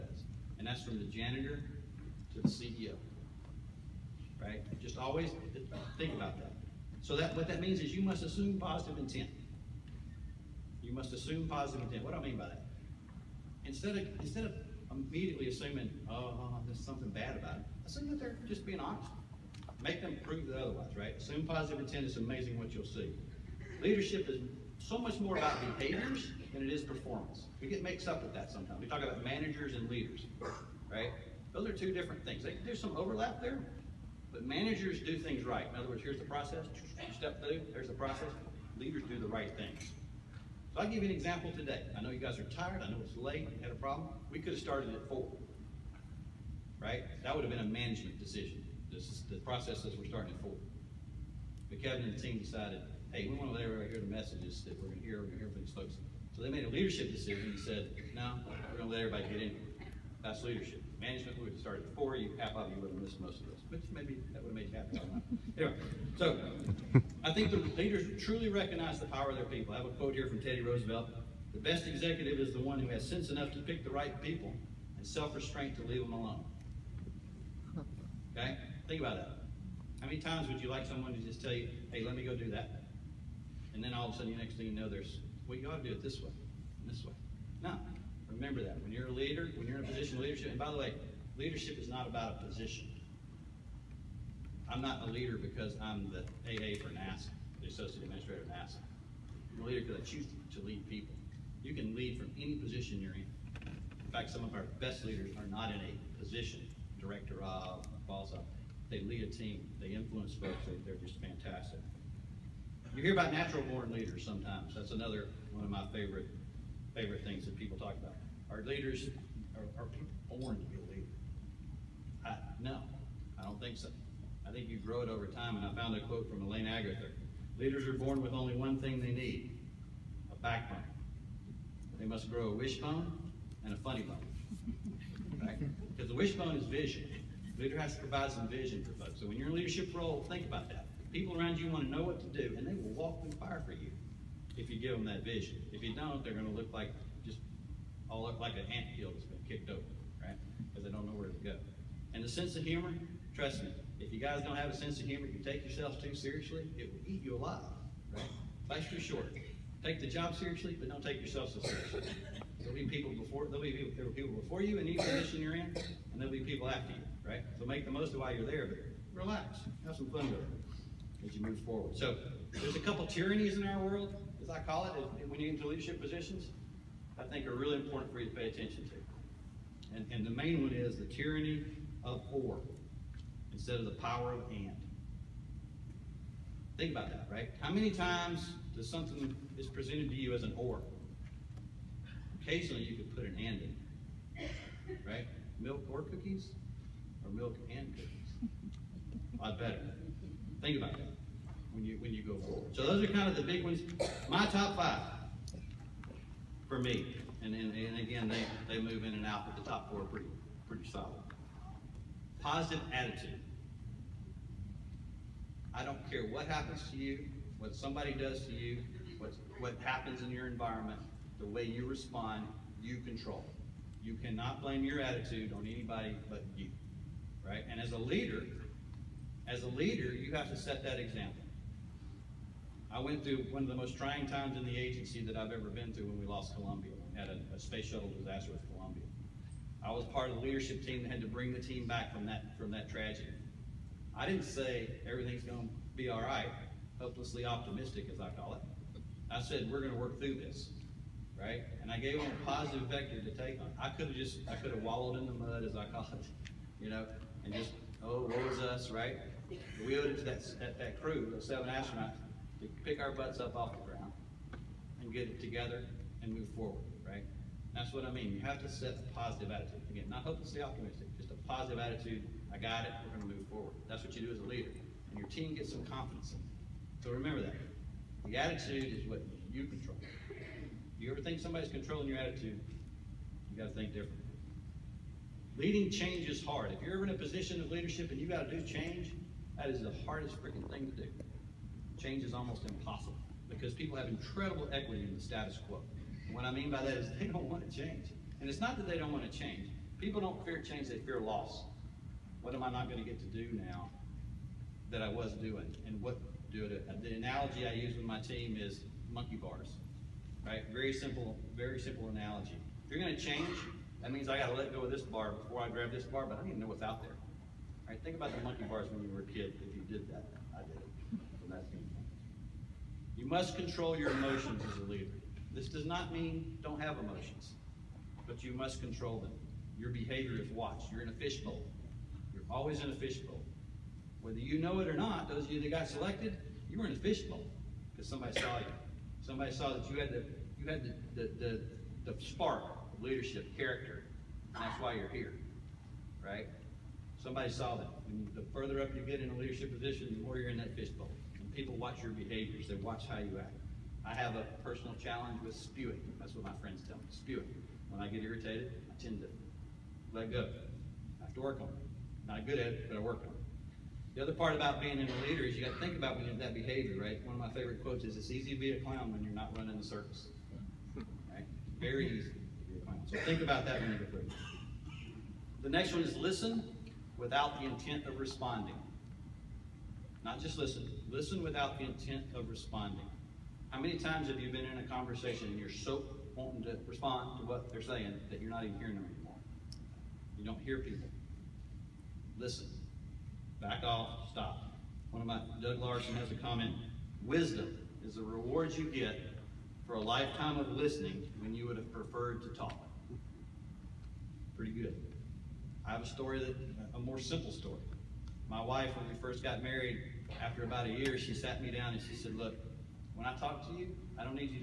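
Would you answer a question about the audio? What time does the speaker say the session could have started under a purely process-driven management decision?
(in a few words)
4.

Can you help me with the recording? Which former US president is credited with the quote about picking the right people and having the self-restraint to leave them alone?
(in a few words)
Teddy Roosevelt.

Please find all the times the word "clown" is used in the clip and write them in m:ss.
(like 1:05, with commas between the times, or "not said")
6:08, 6:12.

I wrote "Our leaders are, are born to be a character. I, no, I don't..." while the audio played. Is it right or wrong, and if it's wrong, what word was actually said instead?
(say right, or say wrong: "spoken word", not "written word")
wrong: "leader", not "character".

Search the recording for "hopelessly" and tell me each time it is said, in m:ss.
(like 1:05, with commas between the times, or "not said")
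4:06, 4:30.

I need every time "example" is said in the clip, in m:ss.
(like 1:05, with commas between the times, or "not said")
0:41, 3:50.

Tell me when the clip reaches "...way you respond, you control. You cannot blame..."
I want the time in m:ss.
3:41.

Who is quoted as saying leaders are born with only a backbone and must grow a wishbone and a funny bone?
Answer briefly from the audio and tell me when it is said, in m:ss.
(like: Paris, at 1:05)
Elaine Agather, at 2:06.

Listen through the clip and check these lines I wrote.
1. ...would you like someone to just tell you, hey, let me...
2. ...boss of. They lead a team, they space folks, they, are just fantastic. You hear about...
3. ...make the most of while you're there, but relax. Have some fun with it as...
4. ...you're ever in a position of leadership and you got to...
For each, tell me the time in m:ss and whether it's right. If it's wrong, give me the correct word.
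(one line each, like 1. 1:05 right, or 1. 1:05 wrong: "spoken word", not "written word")
1. 1:20 right
2. 1:48 wrong: "influence", not "space"
3. 2:47 right
4. 4:46 right.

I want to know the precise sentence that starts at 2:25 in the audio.
If you don't, they're going to look like just all look like an ant hill that's been kicked over, right?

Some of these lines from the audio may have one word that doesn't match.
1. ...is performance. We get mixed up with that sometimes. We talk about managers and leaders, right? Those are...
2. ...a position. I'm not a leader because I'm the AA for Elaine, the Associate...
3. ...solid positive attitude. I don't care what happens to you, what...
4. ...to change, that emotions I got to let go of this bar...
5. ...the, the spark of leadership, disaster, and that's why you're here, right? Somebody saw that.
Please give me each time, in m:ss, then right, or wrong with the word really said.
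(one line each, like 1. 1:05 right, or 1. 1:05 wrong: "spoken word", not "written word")
1. 0:26 right
2. 1:32 wrong: "NASA", not "Elaine"
3. 3:30 right
4. 5:13 wrong: "means", not "emotions"
5. 5:42 wrong: "character", not "disaster".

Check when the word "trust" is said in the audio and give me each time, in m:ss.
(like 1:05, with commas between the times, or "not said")
2:33.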